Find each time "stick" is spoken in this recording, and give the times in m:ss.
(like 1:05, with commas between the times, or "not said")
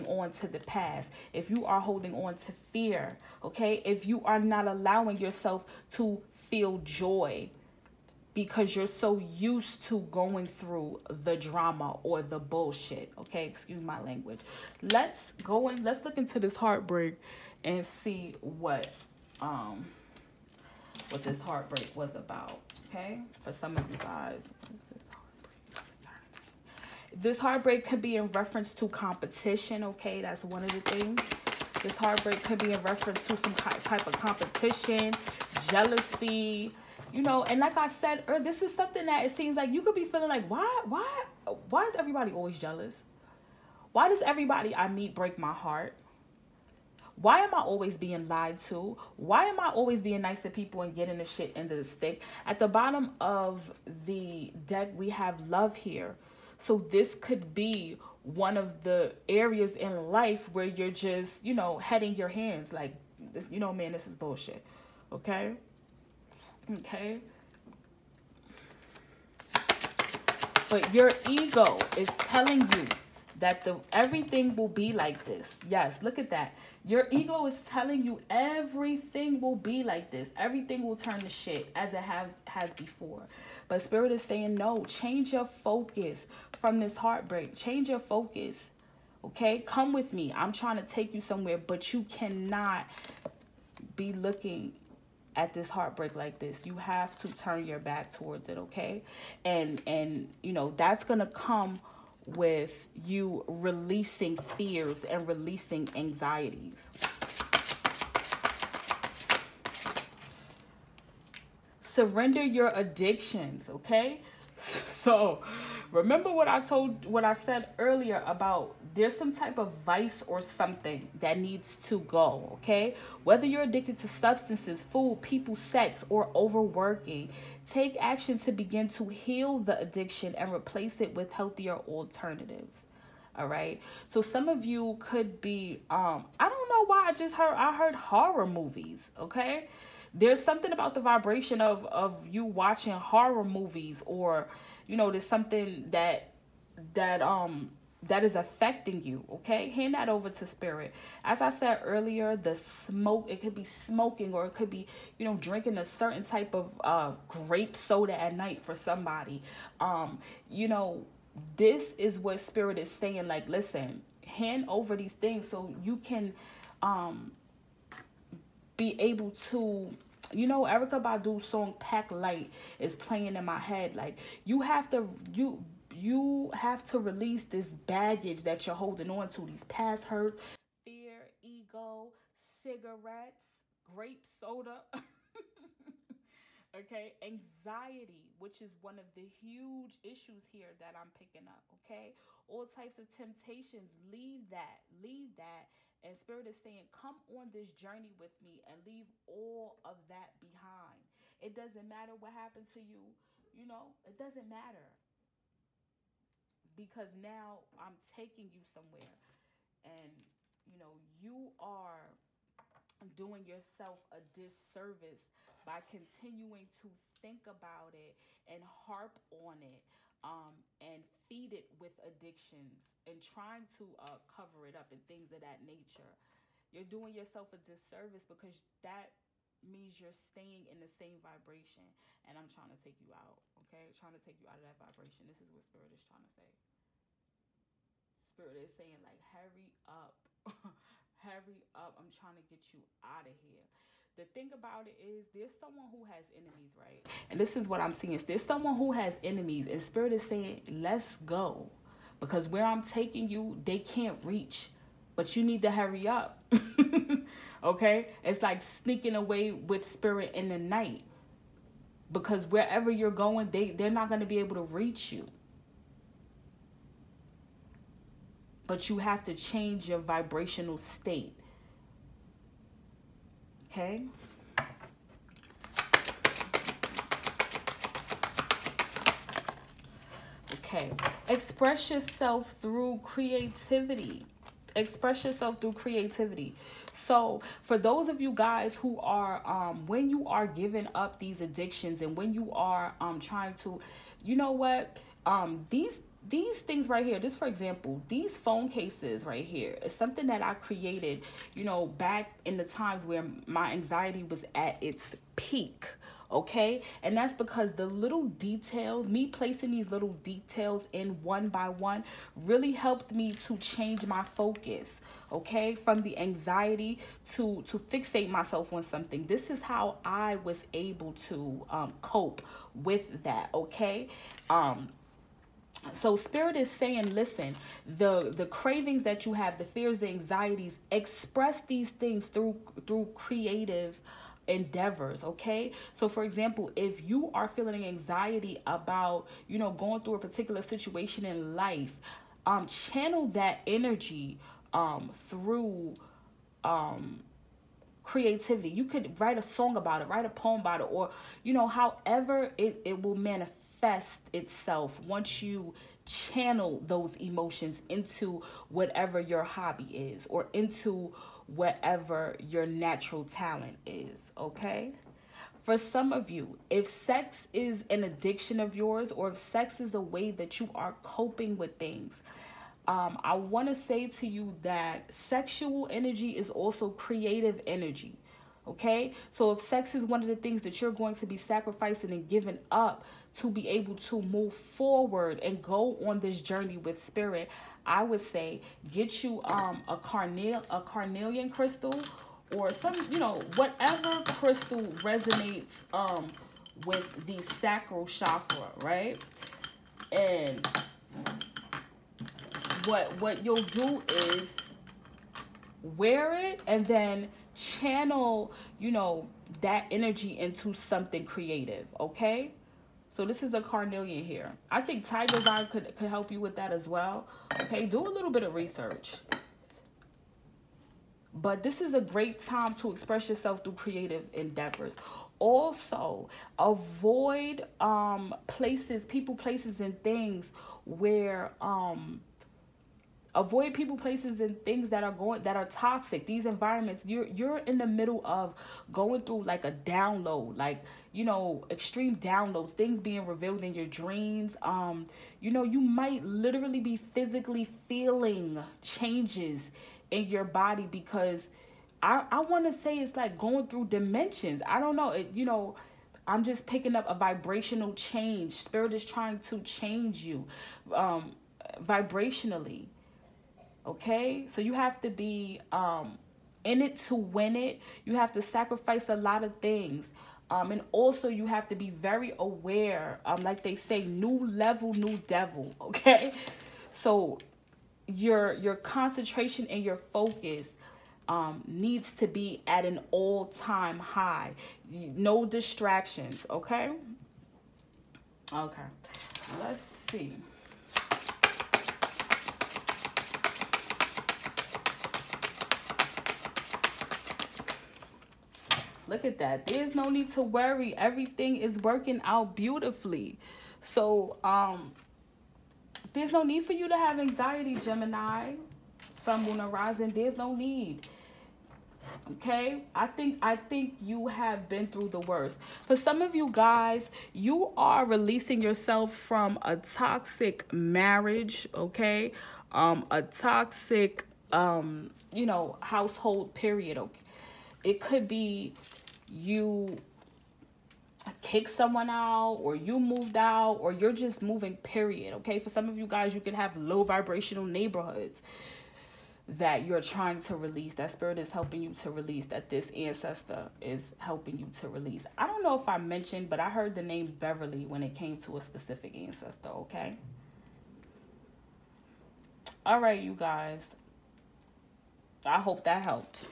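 0:51.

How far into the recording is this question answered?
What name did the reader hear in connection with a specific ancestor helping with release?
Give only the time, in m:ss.
9:07.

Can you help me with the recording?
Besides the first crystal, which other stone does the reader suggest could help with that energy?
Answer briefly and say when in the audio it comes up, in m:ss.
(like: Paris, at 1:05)
Tiger's eye, at 6:55.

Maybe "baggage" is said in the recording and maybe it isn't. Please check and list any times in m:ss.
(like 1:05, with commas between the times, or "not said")
2:57.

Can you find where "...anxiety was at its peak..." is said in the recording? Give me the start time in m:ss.
5:03.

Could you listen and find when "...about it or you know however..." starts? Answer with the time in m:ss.
5:50.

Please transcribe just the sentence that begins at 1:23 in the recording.
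But spirit is saying no, change your focus from this heartbreak.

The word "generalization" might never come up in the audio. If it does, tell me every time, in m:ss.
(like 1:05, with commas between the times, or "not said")
not said.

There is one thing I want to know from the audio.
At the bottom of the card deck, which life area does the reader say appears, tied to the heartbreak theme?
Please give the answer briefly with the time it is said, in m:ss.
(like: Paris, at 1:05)
Love, at 0:55.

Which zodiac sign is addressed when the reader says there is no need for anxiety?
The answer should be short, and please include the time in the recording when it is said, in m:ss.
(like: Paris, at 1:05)
Gemini, at 8:27.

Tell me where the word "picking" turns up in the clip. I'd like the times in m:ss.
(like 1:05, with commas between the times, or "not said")
3:11, 7:36.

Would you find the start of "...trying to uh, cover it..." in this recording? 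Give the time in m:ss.
3:43.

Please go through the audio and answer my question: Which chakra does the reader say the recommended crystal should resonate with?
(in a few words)
Sacral chakra.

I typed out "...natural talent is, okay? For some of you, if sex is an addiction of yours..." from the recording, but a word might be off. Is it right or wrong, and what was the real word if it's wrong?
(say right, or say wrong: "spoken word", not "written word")
right.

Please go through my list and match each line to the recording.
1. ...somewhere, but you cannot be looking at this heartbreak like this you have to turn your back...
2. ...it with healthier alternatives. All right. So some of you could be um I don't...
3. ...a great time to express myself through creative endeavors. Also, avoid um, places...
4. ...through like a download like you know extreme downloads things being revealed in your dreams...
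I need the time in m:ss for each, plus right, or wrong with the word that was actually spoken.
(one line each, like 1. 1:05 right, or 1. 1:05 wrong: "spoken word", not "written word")
1. 1:31 right
2. 2:10 right
3. 7:01 wrong: "yourself", not "myself"
4. 7:19 right.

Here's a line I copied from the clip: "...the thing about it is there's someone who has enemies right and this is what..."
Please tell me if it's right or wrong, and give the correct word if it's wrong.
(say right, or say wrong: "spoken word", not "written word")
right.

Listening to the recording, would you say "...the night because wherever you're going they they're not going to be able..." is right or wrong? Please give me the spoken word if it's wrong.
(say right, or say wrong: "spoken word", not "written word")
right.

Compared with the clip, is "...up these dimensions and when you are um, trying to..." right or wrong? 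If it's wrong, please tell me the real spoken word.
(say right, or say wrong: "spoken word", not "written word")
wrong: "addictions", not "dimensions".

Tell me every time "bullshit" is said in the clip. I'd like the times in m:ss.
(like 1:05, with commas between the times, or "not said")
0:12, 1:04.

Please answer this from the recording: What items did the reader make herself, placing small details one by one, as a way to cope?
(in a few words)
Phone cases.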